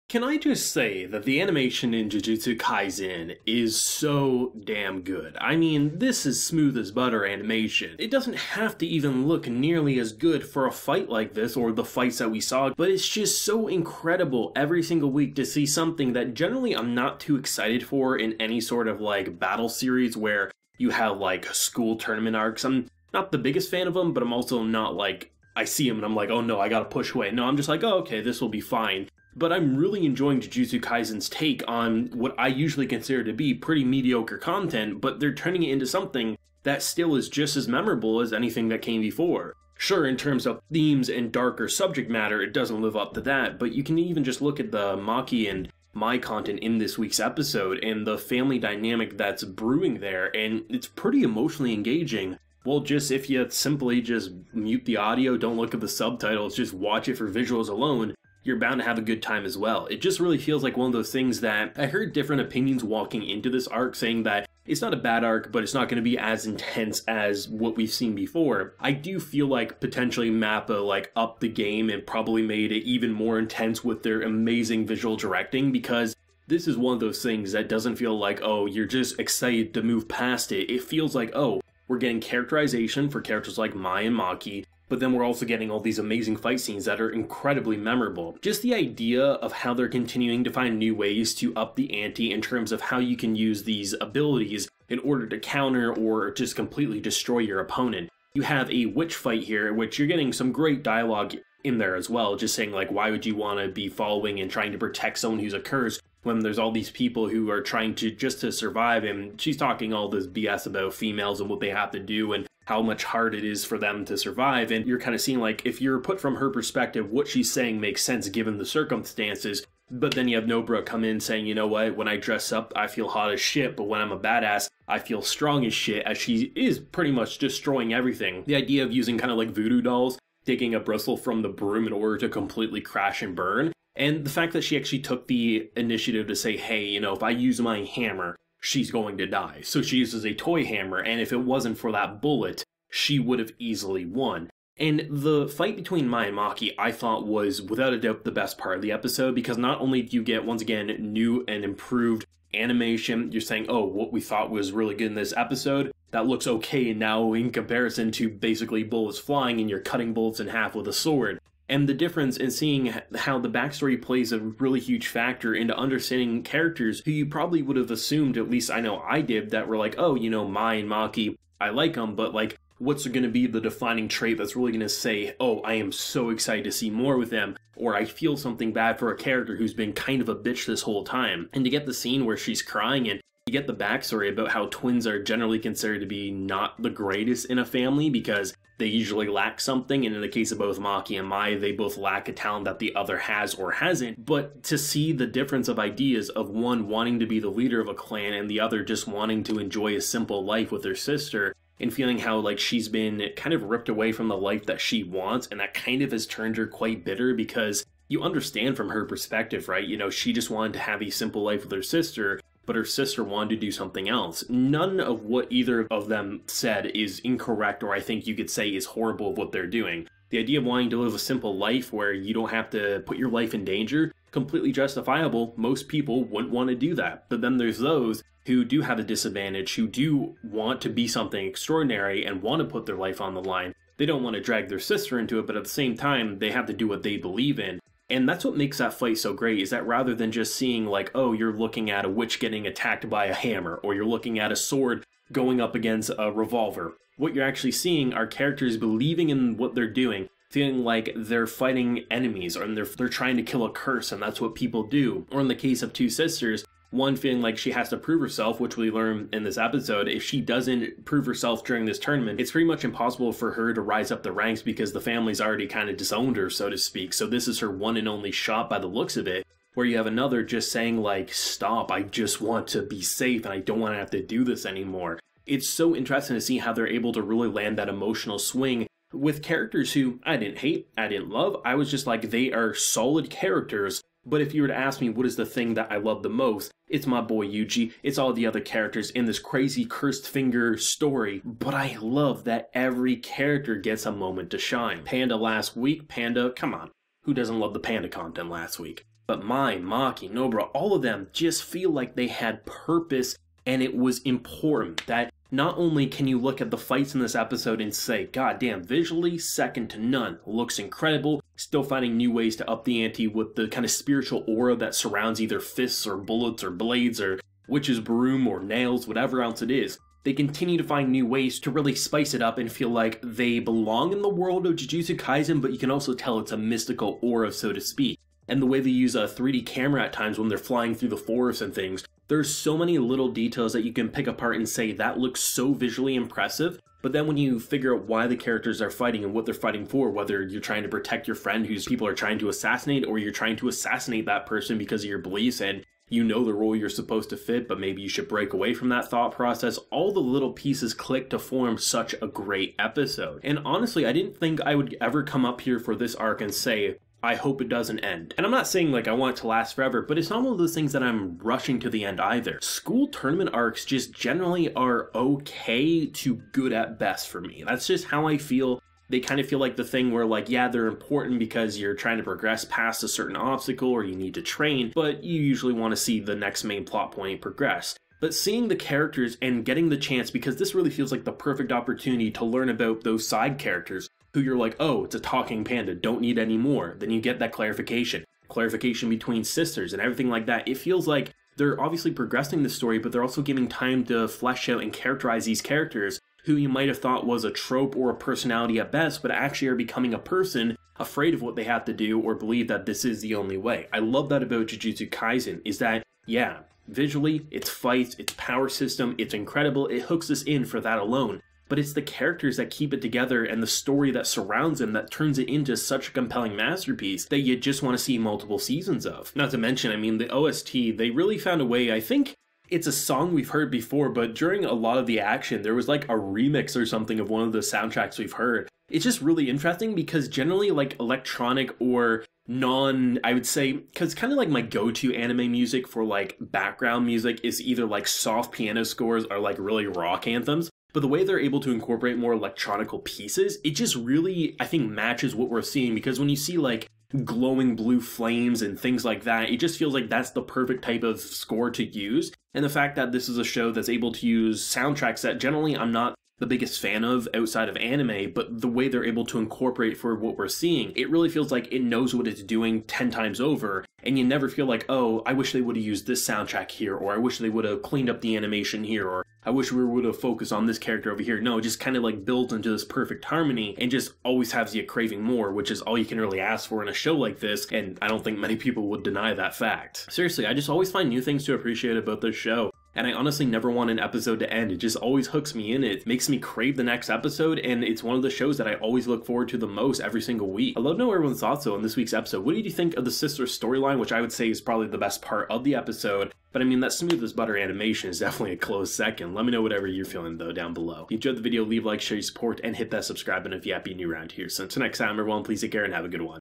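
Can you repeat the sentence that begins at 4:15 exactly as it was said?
Or in the case of Two Sisters, one feeling like she has to prove herself, which we learn in this episode.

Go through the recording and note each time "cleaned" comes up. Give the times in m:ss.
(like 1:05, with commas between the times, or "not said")
7:47.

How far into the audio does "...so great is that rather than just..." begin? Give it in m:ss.
3:59.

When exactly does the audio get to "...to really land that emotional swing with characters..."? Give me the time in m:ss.
4:37.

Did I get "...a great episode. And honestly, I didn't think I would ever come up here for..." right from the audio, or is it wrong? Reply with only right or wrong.
right.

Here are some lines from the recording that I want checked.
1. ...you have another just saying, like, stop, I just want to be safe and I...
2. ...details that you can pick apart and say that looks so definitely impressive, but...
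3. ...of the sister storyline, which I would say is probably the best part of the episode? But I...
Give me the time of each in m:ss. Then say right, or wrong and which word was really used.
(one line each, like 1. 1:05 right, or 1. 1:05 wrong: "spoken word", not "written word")
1. 4:29 right
2. 5:33 wrong: "visually", not "definitely"
3. 8:12 right.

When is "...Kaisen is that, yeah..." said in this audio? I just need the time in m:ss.
6:45.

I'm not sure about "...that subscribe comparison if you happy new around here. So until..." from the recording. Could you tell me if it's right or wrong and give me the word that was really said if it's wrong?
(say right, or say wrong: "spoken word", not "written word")
wrong: "button", not "comparison".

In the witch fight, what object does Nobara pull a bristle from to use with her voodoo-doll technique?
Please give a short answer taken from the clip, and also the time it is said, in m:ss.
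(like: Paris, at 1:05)
the broom, at 2:11.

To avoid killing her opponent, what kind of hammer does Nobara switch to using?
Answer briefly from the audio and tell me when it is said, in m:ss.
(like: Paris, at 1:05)
a toy hammer, at 2:20.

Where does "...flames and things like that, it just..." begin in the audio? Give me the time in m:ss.
7:28.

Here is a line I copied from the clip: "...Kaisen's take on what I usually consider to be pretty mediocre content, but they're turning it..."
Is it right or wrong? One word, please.
right.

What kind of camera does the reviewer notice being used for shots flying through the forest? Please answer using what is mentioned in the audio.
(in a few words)
3D camera.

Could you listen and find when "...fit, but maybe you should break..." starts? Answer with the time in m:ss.
5:47.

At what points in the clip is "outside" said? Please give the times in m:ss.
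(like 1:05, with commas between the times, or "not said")
7:37.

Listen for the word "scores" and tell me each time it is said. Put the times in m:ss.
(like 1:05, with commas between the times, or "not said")
7:18, 7:31.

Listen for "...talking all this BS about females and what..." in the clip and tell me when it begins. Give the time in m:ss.
1:49.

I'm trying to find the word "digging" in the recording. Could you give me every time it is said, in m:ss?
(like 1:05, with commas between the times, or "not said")
2:10.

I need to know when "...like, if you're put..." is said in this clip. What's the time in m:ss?
1:55.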